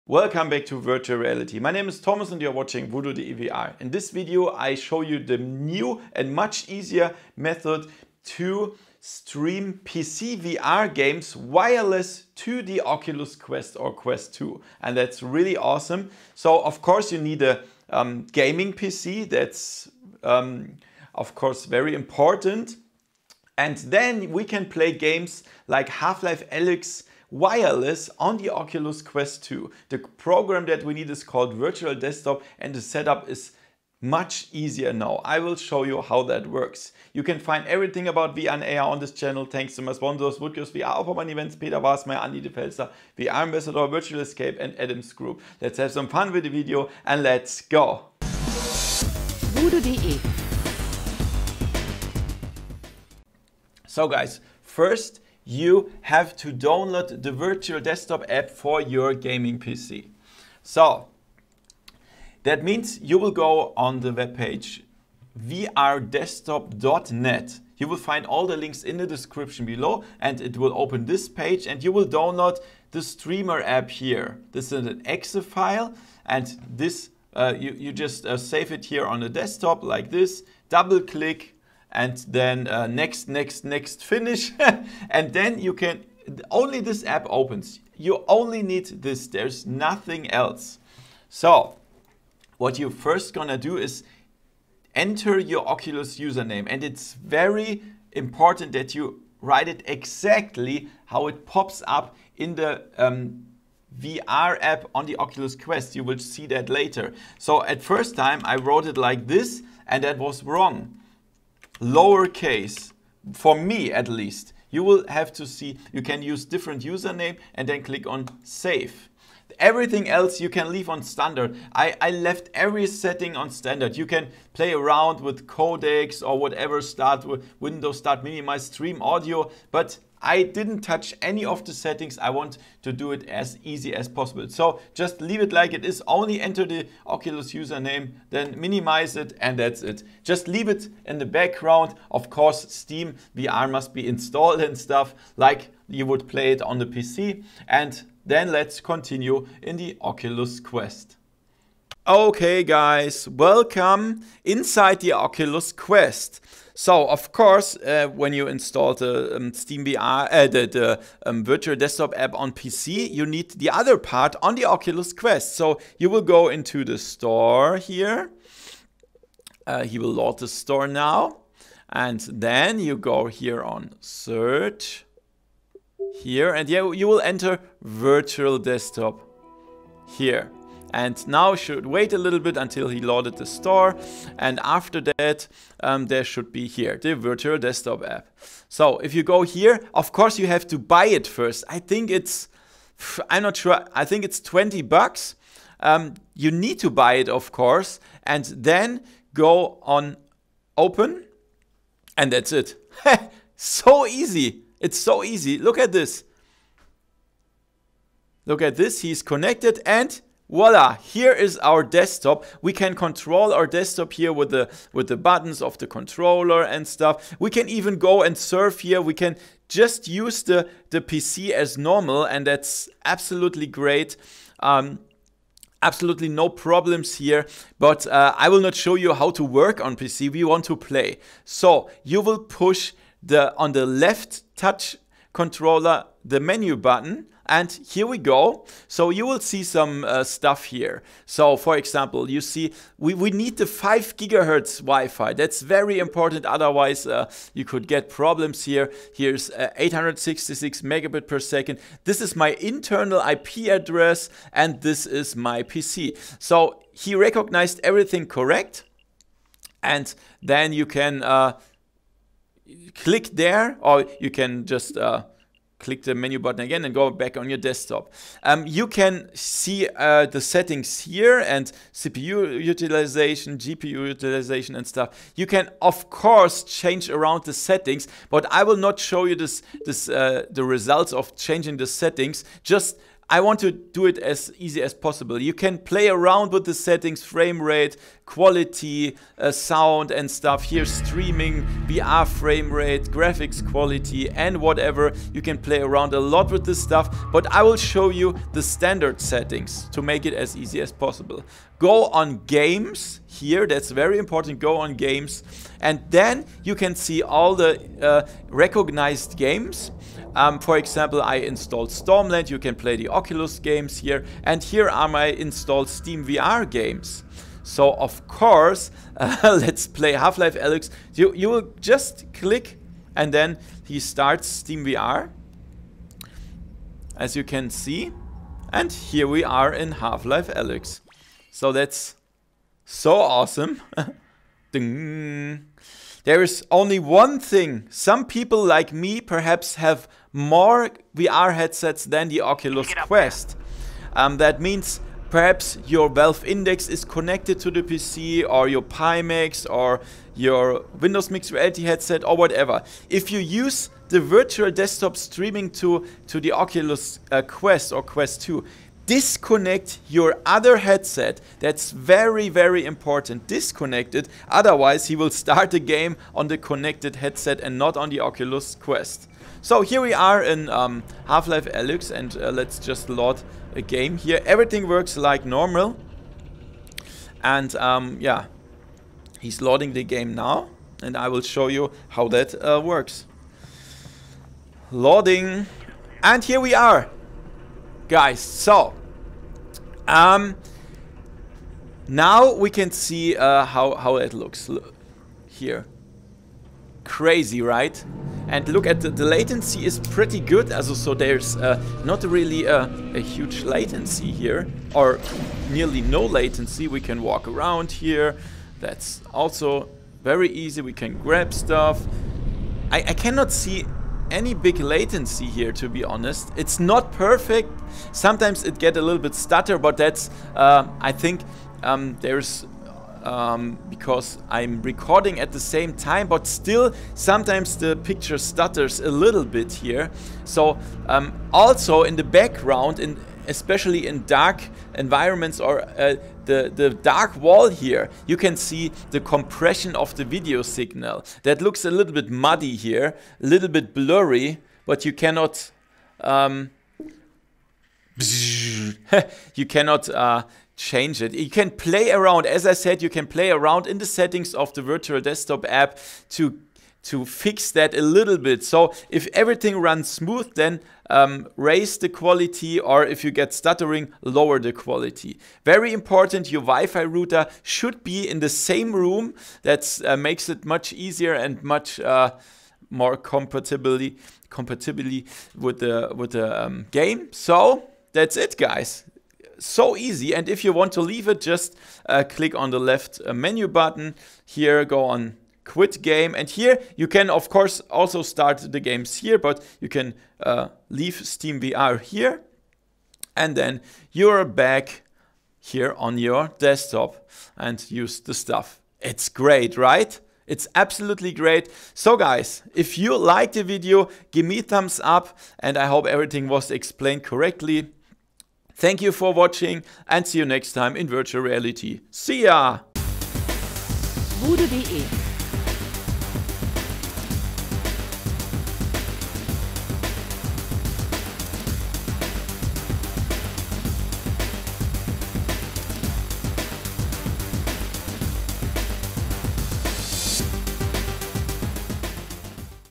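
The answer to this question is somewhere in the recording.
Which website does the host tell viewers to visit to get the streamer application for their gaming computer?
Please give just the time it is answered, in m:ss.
1:05.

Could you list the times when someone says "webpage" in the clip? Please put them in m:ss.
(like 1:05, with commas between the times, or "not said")
1:04.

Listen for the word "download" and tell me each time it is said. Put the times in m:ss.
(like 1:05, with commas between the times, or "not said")
0:56, 1:12.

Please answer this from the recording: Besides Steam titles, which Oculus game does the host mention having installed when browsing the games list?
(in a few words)
Stormland.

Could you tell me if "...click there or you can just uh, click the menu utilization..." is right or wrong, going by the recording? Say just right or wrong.
wrong.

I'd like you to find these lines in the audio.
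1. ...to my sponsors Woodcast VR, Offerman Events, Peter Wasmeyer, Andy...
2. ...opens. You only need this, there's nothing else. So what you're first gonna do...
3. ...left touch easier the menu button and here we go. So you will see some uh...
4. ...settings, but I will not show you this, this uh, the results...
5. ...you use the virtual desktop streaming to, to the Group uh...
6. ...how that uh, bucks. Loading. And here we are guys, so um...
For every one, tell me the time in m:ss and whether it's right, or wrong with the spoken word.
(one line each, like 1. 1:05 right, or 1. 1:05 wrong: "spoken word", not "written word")
1. 0:39 right
2. 1:27 right
3. 3:53 wrong: "controller", not "easier"
4. 4:37 right
5. 5:53 wrong: "Oculus", not "Group"
6. 6:22 wrong: "works", not "bucks".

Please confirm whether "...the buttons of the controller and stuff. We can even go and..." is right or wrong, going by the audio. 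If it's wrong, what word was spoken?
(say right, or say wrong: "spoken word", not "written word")
right.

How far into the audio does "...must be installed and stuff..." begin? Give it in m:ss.
2:23.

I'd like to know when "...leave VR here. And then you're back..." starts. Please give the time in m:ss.
8:10.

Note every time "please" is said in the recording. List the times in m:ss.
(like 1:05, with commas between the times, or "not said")
not said.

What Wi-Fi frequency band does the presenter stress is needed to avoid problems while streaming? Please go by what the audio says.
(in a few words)
5 gigahertz.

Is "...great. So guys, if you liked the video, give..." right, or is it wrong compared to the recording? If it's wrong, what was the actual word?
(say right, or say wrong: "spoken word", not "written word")
right.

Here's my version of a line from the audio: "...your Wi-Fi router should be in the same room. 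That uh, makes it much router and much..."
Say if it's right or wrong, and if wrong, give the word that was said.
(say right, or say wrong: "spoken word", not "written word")
wrong: "easier", not "router".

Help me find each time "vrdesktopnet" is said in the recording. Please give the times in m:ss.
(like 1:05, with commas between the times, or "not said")
1:05.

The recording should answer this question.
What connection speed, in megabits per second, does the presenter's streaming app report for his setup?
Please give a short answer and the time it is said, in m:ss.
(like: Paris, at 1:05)
866, at 4:09.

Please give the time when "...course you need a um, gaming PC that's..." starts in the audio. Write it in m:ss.
0:16.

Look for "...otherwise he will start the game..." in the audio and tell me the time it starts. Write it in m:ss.
6:04.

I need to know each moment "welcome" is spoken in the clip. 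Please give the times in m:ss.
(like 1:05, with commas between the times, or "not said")
0:00, 2:33.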